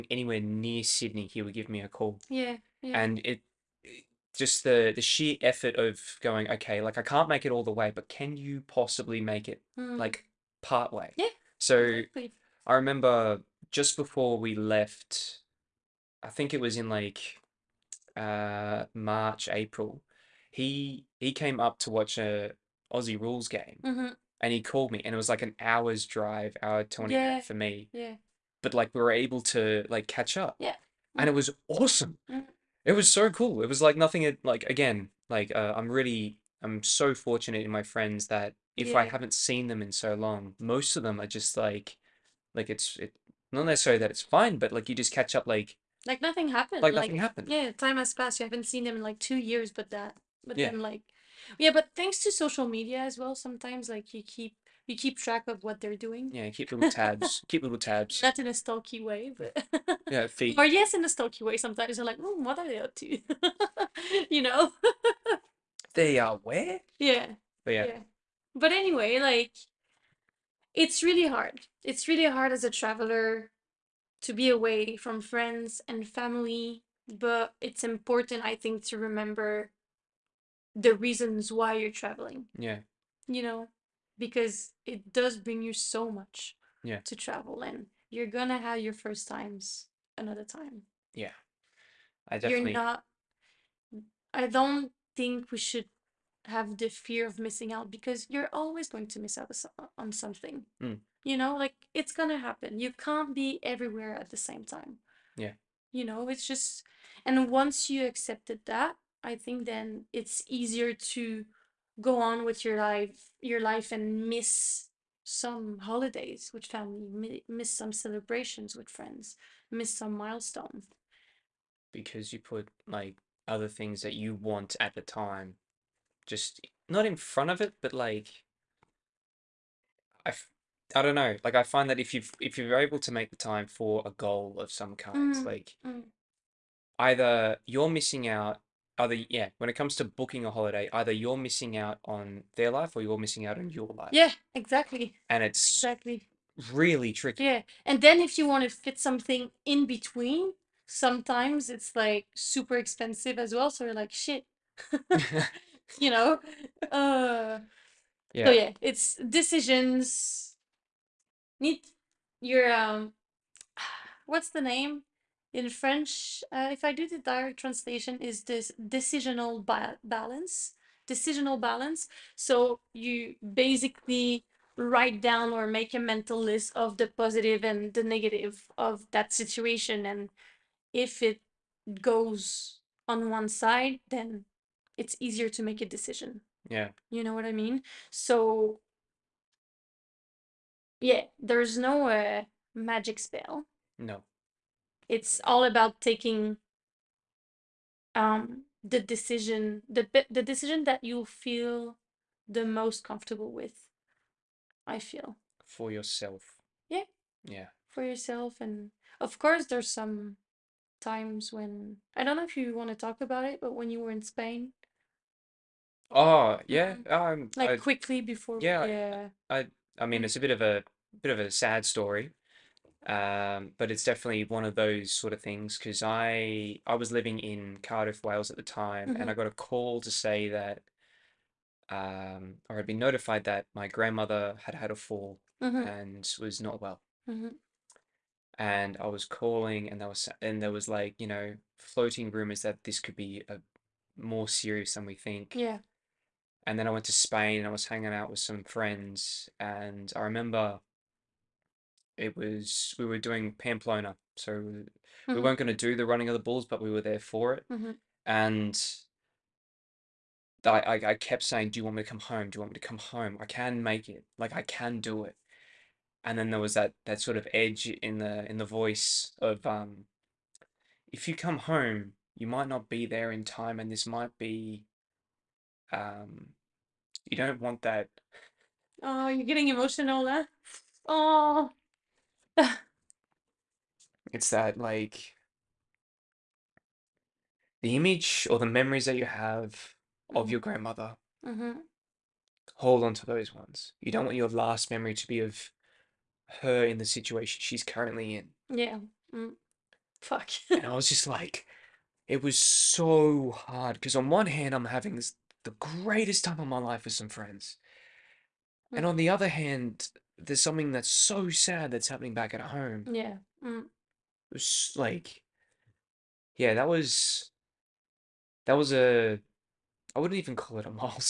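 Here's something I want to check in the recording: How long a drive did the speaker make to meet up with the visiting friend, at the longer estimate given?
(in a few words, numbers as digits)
Hour twenty.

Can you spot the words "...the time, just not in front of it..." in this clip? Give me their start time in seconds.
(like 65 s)
124 s.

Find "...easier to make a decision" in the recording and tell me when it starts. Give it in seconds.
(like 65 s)
185 s.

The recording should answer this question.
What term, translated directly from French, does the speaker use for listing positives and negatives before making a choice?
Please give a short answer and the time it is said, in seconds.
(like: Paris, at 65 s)
Decisional balance, at 168 s.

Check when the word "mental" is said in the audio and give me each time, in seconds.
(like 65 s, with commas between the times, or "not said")
175 s.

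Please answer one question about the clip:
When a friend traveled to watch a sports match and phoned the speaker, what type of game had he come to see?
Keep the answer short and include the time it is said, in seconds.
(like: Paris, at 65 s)
Aussie Rules, at 22 s.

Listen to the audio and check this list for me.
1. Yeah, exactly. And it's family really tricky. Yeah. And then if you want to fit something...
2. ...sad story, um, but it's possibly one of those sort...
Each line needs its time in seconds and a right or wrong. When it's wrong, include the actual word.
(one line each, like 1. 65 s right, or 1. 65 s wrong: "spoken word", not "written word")
1. 144 s wrong: "exactly", not "family"
2. 221 s wrong: "definitely", not "possibly".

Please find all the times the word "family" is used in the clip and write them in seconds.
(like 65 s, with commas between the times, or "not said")
76 s, 116 s.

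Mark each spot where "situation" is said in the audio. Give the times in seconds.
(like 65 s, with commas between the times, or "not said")
179 s, 297 s.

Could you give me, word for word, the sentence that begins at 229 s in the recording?
got a call to say that, um, or I'd been notified that my grandmother had had a fall Mm-hmm.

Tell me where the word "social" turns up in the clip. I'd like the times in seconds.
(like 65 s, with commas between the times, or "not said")
52 s.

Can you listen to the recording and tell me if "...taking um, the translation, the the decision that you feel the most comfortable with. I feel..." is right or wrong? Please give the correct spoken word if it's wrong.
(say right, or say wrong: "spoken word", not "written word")
wrong: "decision", not "translation".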